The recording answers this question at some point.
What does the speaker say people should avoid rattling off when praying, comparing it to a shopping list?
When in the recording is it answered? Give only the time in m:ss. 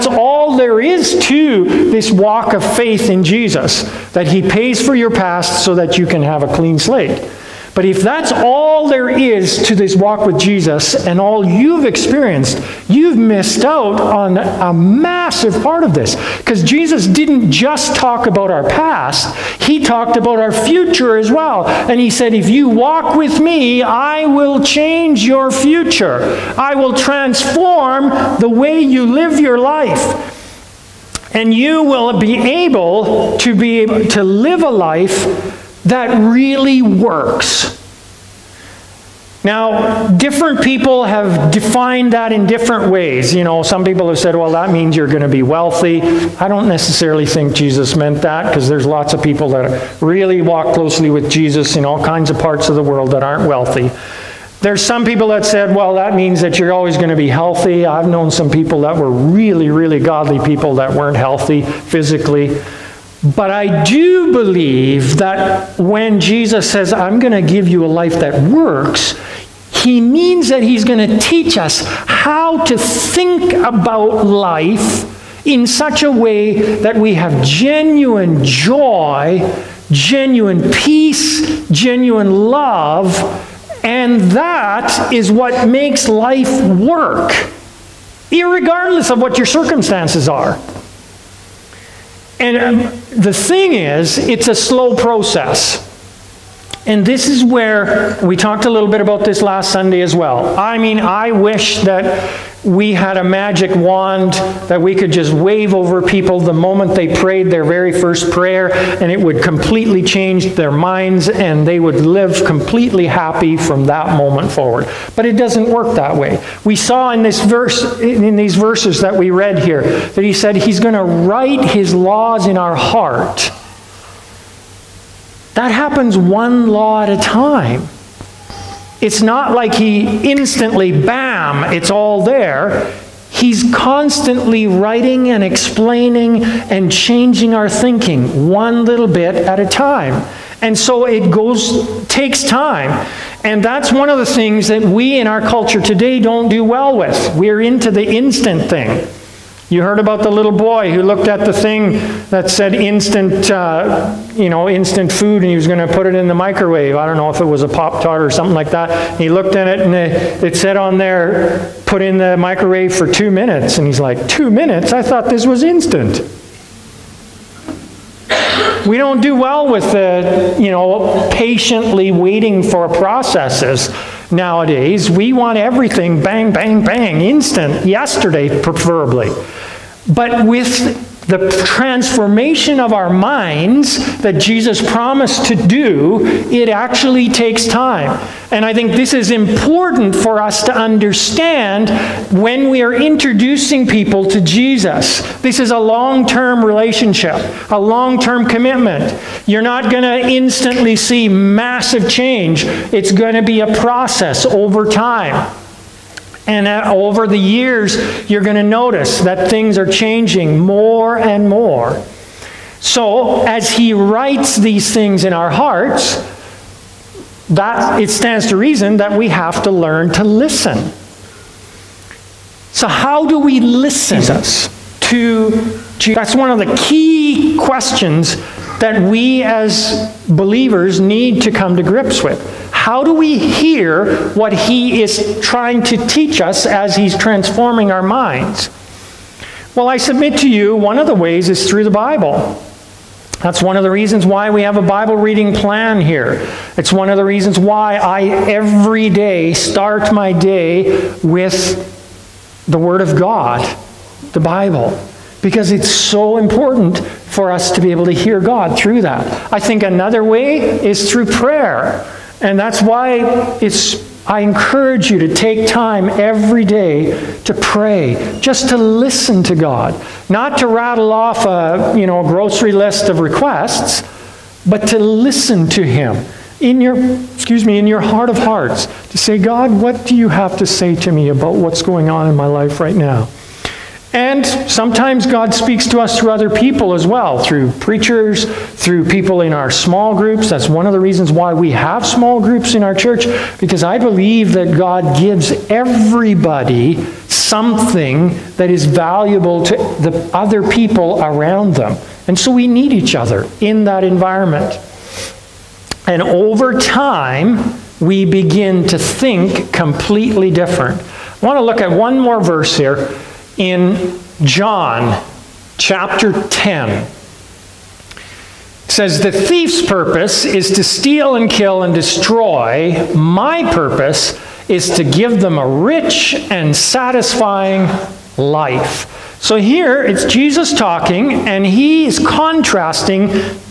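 4:32.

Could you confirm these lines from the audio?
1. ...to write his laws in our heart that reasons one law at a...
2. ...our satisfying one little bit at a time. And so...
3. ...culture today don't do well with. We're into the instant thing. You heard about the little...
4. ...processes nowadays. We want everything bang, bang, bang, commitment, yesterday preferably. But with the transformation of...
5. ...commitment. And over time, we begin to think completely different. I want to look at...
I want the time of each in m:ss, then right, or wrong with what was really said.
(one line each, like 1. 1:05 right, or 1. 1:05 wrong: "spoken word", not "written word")
1. 2:00 wrong: "happens", not "reasons"
2. 2:17 wrong: "thinking", not "satisfying"
3. 2:25 right
4. 2:52 wrong: "instant", not "commitment"
5. 5:04 wrong: "environment", not "commitment".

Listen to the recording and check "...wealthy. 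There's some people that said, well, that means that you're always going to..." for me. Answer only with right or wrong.
right.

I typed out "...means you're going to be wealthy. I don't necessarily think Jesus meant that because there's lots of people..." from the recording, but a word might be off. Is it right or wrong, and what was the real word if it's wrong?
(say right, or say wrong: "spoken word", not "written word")
right.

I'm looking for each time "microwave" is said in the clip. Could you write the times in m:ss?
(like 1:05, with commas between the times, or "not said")
2:36, 2:42.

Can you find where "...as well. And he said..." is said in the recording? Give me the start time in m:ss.
0:21.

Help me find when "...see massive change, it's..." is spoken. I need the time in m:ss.
3:20.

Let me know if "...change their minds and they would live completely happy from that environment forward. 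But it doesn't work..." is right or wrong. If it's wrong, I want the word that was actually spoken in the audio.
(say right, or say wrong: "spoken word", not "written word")
wrong: "moment", not "environment".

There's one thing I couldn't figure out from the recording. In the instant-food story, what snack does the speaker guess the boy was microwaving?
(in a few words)
Pop Tart.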